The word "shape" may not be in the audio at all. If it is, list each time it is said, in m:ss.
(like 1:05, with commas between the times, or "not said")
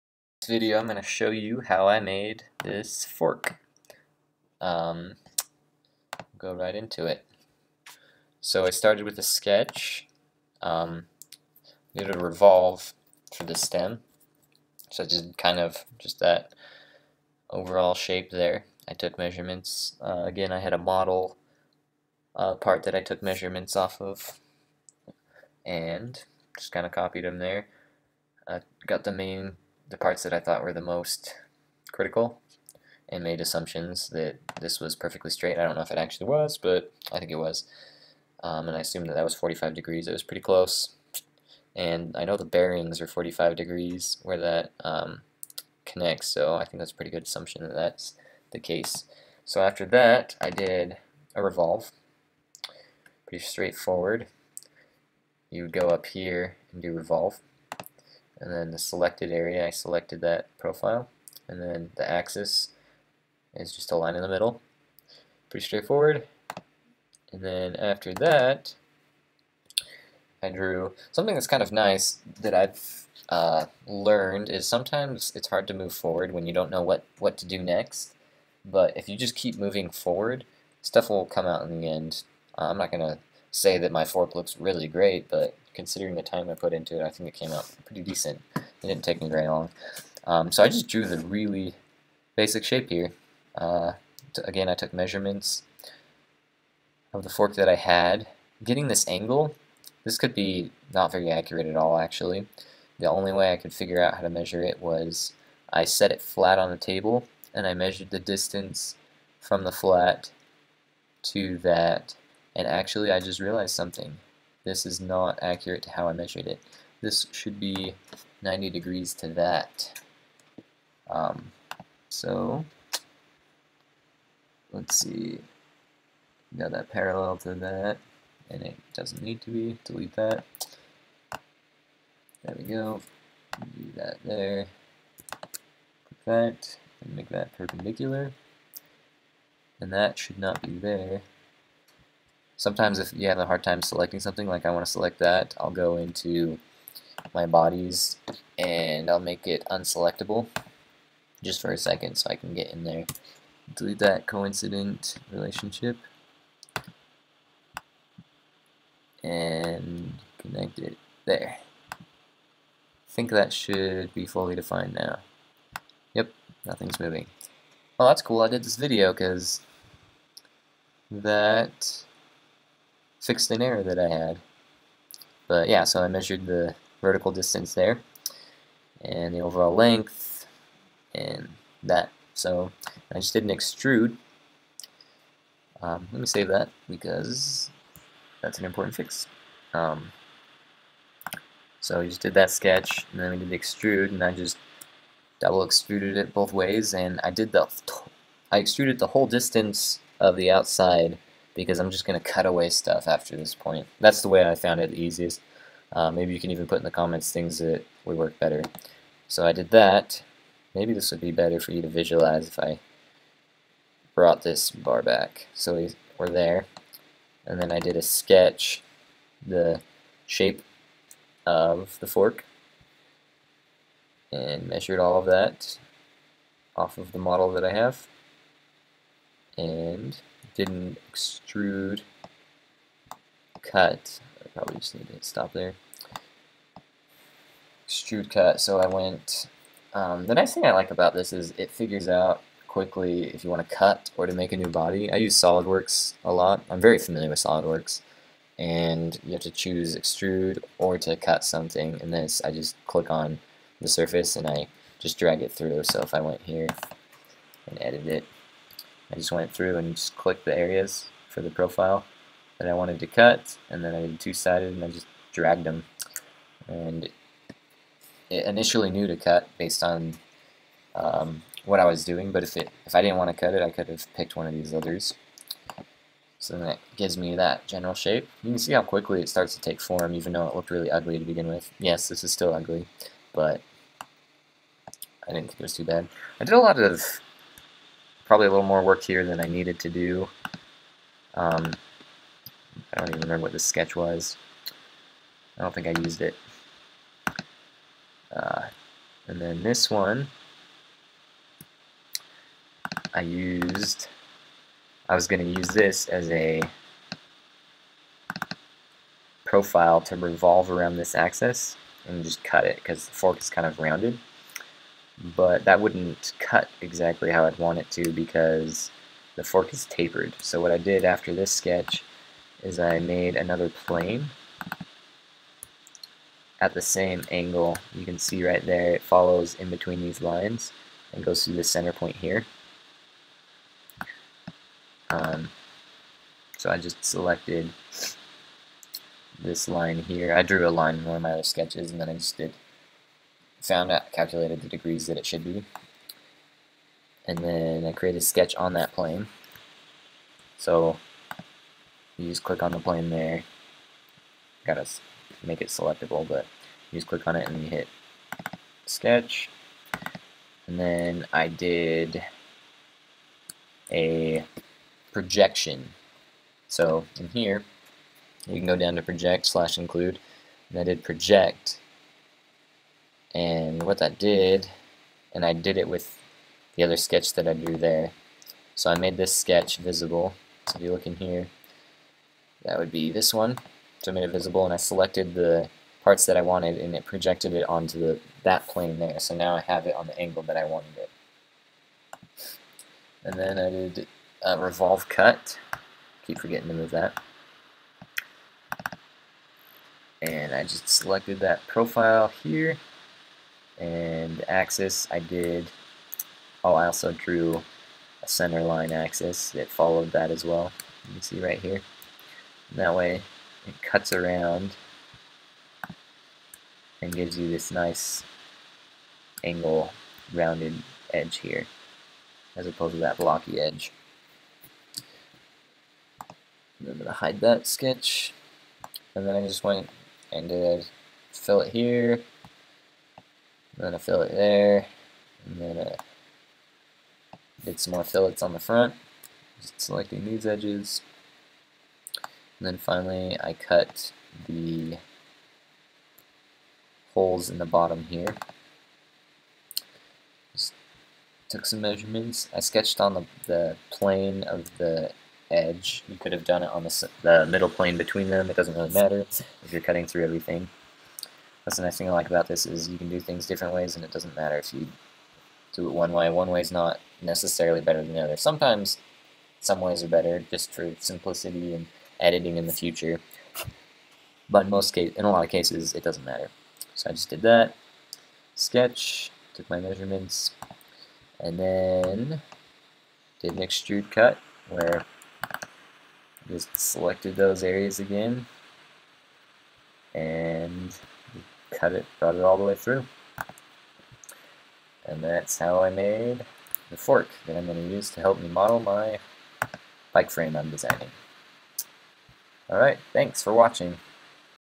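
0:17, 1:32, 3:40, 4:37.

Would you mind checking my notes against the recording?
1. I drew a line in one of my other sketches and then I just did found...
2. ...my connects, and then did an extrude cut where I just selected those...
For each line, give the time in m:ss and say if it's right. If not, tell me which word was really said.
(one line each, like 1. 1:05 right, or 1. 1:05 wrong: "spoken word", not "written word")
1. 5:40 right
2. 7:59 wrong: "measurements", not "connects".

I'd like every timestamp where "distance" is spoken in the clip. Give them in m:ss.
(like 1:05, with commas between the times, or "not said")
1:48, 2:57, 3:19.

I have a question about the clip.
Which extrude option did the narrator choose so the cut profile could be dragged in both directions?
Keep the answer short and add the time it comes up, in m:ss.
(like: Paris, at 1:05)
two-sided, at 4:24.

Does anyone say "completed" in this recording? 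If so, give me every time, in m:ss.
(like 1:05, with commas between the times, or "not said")
not said.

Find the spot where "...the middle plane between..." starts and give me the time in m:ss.
7:37.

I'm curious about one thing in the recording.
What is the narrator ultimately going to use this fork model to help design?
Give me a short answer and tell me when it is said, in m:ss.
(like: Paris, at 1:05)
bike frame, at 8:20.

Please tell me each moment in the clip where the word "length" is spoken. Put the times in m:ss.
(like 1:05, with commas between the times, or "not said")
2:59.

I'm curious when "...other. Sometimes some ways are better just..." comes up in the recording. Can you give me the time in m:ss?
7:48.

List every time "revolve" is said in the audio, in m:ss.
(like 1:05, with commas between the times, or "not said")
0:12, 0:51, 0:56, 5:10, 6:34.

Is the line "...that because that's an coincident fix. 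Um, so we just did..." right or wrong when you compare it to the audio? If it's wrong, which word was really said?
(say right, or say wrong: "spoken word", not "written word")
wrong: "important", not "coincident".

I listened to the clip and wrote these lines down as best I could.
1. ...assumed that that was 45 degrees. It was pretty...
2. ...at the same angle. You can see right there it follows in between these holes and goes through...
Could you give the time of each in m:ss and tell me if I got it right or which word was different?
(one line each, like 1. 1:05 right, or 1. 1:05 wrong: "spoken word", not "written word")
1. 0:38 right
2. 5:26 wrong: "lines", not "holes".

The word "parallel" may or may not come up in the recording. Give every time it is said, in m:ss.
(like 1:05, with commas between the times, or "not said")
2:06.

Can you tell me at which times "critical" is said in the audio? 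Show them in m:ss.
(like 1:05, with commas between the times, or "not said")
0:31.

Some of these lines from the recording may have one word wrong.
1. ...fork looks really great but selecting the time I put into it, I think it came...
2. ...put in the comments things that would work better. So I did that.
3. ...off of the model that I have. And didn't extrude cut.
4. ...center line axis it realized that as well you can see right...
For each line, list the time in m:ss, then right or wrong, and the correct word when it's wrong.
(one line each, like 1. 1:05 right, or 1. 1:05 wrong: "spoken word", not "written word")
1. 1:24 wrong: "considering", not "selecting"
2. 3:26 right
3. 3:46 right
4. 6:48 wrong: "followed", not "realized".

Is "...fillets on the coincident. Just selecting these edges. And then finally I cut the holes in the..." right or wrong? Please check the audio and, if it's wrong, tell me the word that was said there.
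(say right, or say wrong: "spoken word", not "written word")
wrong: "front", not "coincident".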